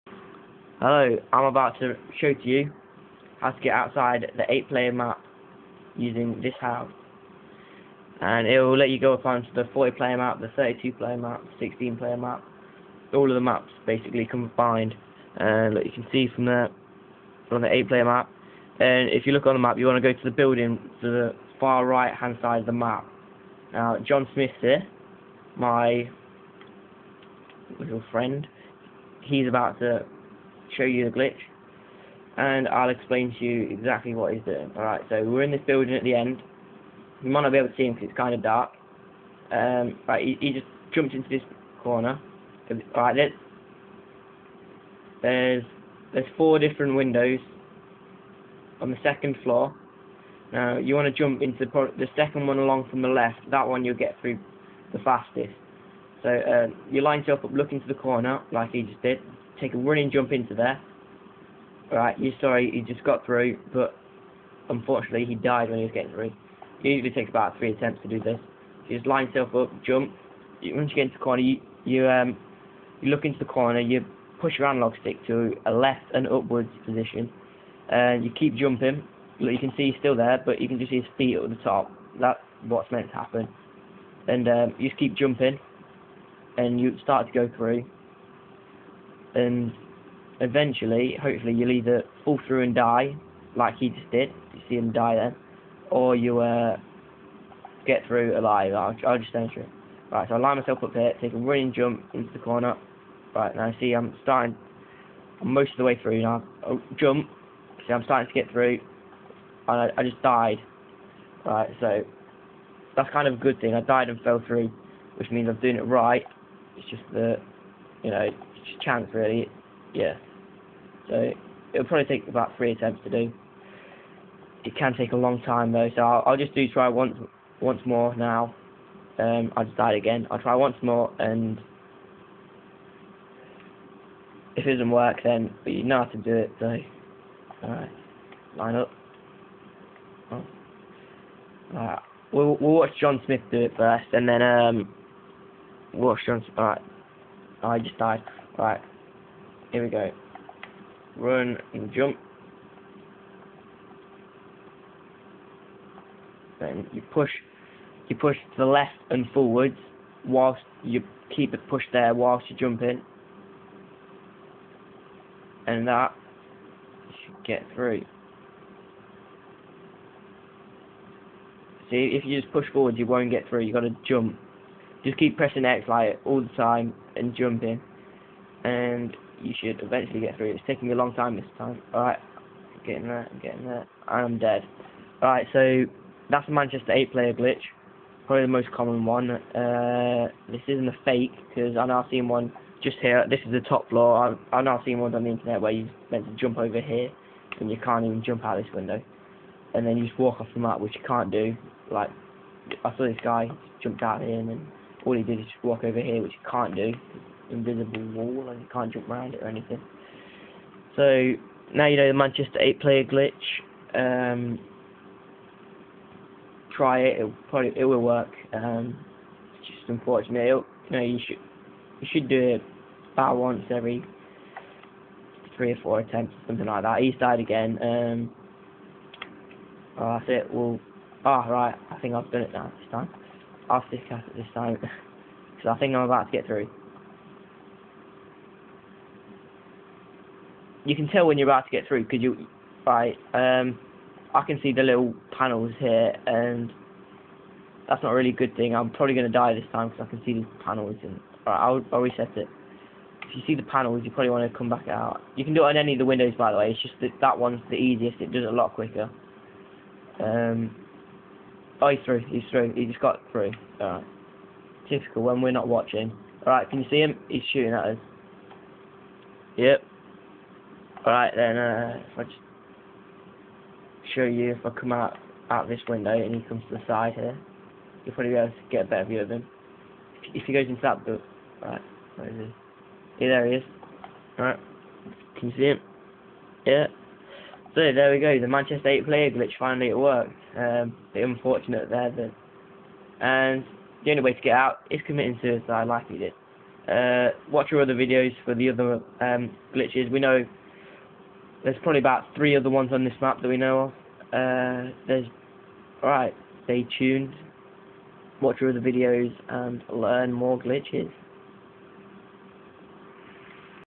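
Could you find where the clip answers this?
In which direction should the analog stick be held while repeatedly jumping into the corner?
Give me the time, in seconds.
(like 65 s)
75 s.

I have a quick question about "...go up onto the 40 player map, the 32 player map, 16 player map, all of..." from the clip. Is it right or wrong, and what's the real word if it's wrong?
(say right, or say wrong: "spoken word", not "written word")
right.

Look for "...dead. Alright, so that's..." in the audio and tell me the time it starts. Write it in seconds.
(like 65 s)
184 s.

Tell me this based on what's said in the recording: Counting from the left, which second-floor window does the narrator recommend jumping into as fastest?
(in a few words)
The second one.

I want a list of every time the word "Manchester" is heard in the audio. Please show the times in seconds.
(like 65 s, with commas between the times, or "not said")
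186 s, 212 s, 288 s.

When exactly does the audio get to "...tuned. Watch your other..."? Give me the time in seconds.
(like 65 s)
306 s.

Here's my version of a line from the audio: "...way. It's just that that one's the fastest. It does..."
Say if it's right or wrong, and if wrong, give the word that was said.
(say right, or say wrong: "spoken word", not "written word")
wrong: "easiest", not "fastest".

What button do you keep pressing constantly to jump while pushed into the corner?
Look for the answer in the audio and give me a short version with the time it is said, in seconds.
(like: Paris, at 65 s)
X, at 175 s.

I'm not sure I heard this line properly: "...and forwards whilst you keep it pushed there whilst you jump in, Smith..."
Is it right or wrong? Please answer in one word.
wrong.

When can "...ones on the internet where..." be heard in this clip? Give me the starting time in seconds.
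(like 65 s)
194 s.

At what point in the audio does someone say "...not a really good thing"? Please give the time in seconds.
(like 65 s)
248 s.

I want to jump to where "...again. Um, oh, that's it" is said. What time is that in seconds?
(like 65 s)
227 s.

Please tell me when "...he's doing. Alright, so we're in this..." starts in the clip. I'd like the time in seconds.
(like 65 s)
34 s.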